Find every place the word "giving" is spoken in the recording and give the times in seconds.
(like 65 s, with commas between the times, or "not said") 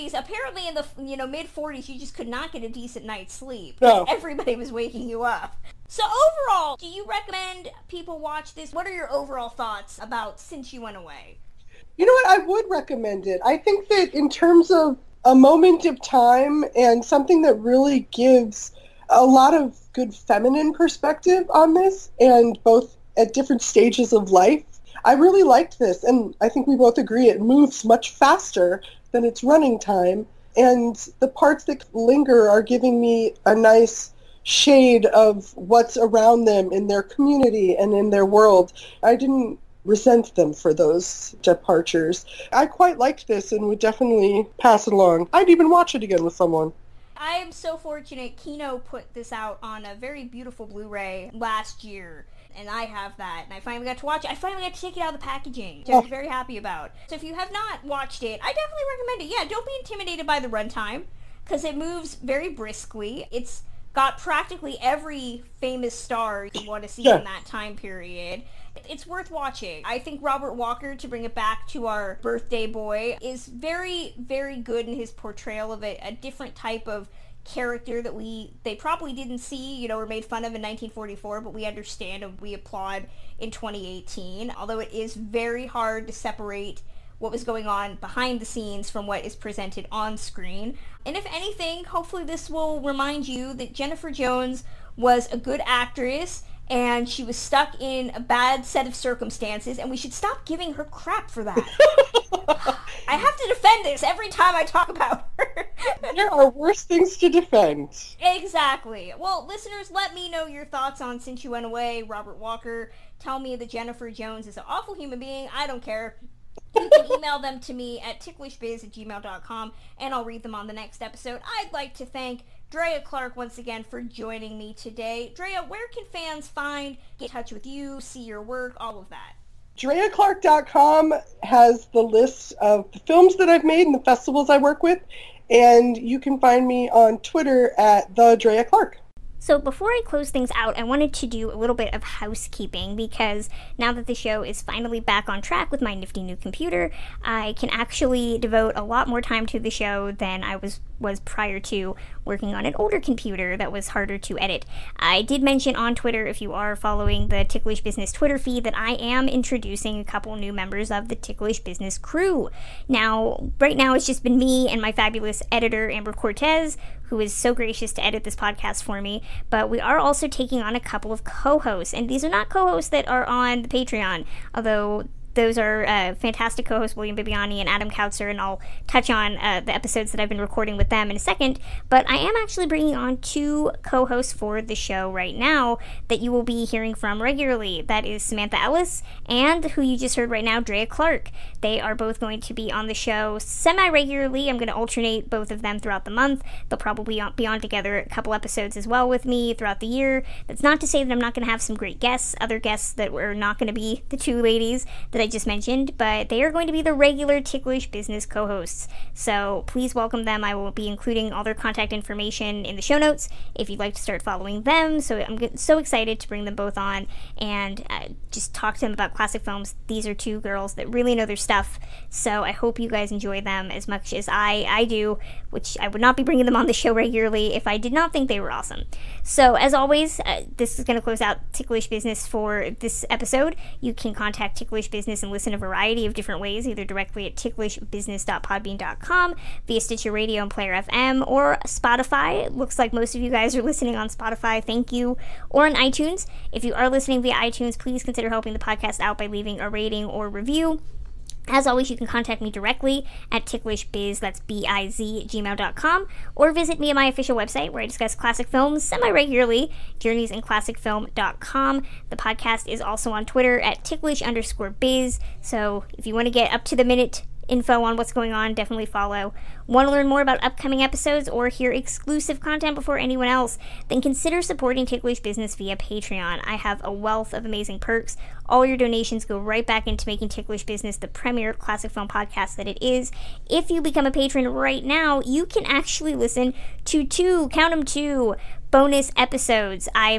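32 s, 100 s.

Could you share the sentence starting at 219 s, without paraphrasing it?
These are two girls that really know their stuff.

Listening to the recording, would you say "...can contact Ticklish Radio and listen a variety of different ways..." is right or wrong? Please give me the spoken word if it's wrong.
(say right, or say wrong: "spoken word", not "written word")
wrong: "Business", not "Radio".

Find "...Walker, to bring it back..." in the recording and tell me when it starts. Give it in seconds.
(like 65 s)
70 s.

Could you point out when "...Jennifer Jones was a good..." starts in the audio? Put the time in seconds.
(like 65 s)
93 s.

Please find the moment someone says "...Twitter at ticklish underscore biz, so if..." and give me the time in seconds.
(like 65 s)
263 s.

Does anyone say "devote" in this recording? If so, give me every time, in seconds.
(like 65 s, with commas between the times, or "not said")
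148 s.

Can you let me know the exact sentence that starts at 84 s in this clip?
Although it is very hard to separate what was going on behind the scenes from what is presented on screen.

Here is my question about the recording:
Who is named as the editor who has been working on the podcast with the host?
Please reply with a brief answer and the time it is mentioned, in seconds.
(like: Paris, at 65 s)
Amber Cortes, at 165 s.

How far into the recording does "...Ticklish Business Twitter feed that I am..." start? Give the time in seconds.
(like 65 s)
157 s.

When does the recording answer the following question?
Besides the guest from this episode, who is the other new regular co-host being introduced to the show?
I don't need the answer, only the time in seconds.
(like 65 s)
188 s.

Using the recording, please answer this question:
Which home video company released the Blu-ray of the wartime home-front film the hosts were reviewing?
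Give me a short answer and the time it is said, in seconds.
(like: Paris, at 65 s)
Kino, at 48 s.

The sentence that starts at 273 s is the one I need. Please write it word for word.
Then consider supporting Ticklish Business via Patreon.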